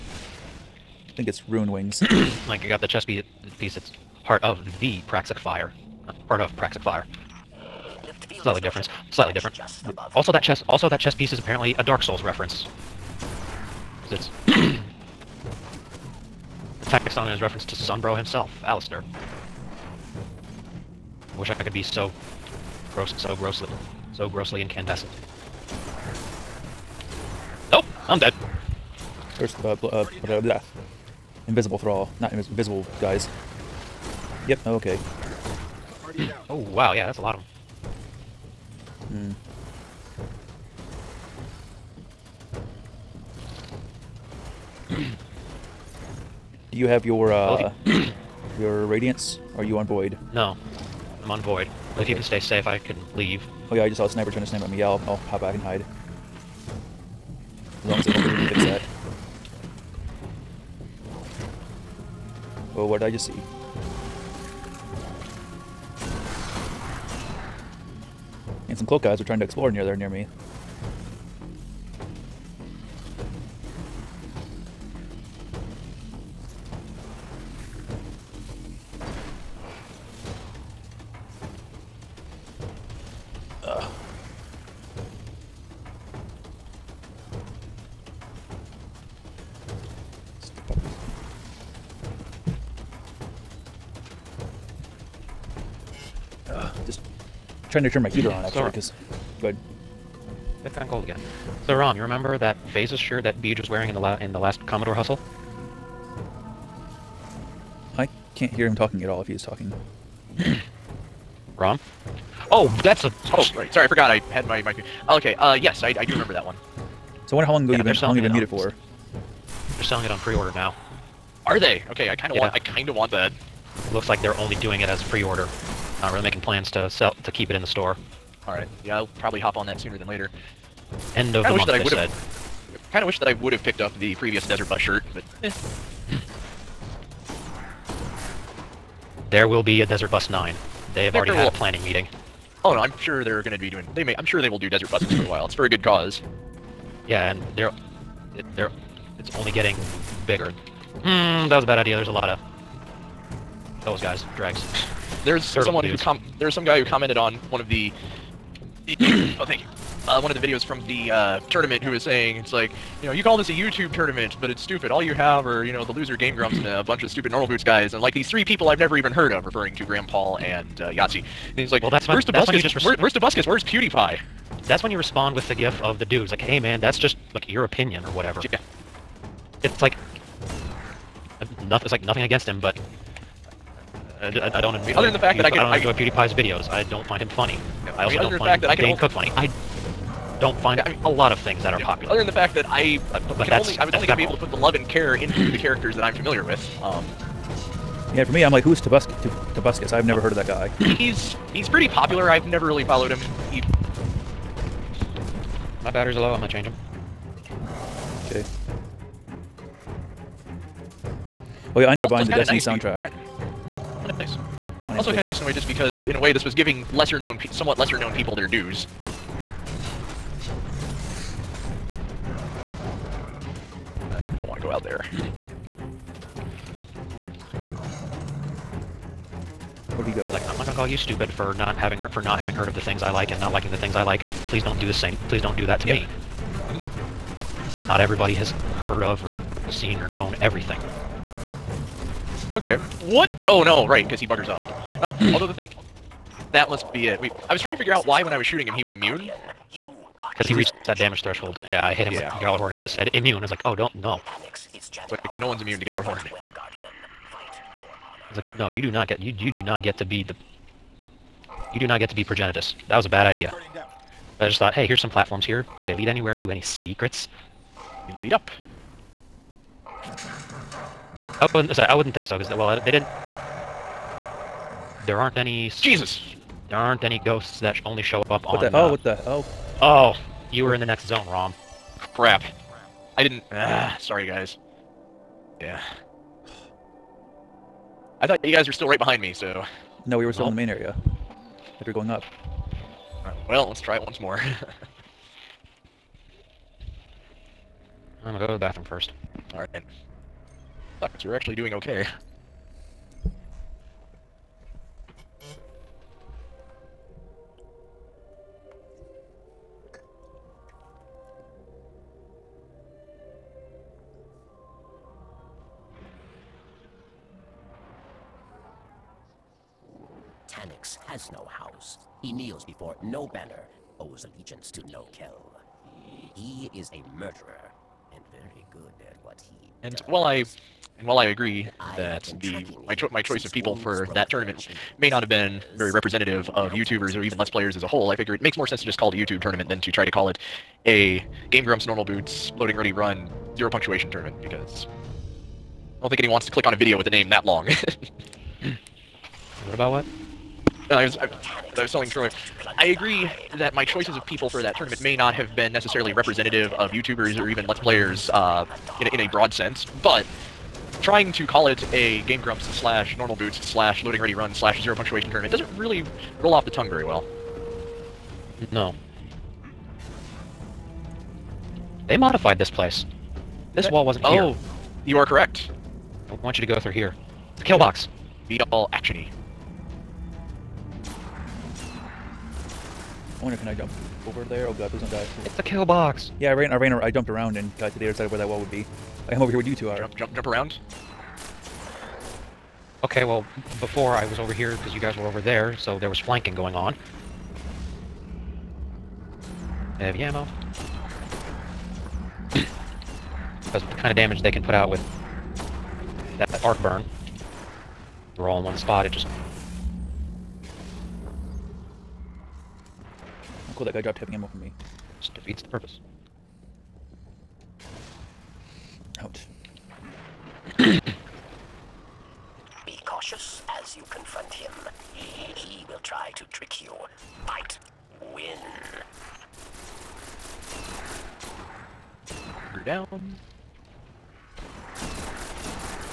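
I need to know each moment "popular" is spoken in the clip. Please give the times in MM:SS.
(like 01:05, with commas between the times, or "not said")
03:11, 03:21.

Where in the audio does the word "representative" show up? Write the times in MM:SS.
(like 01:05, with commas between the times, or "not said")
05:35, 05:56.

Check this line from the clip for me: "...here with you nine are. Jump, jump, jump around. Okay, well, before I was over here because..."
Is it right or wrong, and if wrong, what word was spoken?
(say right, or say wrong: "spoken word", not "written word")
wrong: "two", not "nine".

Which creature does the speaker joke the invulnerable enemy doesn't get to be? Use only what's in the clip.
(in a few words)
Progenitus.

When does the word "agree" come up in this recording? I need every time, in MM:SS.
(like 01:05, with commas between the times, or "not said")
05:31, 05:52.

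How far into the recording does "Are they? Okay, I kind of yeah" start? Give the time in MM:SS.
02:01.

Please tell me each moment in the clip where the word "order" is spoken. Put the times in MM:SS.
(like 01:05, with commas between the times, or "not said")
02:00, 02:05.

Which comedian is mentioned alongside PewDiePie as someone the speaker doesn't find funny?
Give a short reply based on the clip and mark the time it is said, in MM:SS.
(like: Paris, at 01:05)
Dane Cook, at 03:08.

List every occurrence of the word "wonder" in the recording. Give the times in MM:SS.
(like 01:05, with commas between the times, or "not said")
01:57, 06:23.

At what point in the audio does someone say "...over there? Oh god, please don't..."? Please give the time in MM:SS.
06:24.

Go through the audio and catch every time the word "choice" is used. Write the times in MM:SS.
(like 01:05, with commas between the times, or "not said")
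05:33, 05:53.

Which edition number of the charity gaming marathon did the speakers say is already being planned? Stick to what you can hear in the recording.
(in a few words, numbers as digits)
Desert Bus 9.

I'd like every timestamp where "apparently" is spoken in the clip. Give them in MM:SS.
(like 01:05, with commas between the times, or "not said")
00:11.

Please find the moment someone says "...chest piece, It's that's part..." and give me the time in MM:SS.
00:02.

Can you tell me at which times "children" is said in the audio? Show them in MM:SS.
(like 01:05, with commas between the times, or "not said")
not said.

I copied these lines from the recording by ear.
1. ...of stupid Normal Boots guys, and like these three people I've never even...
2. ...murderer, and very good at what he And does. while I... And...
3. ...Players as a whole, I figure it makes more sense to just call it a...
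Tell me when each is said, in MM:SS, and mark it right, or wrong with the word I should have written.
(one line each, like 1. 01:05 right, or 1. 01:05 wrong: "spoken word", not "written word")
1. 02:47 right
2. 05:27 right
3. 05:37 right.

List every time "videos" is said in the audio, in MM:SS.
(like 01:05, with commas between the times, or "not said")
02:40, 03:06, 05:46.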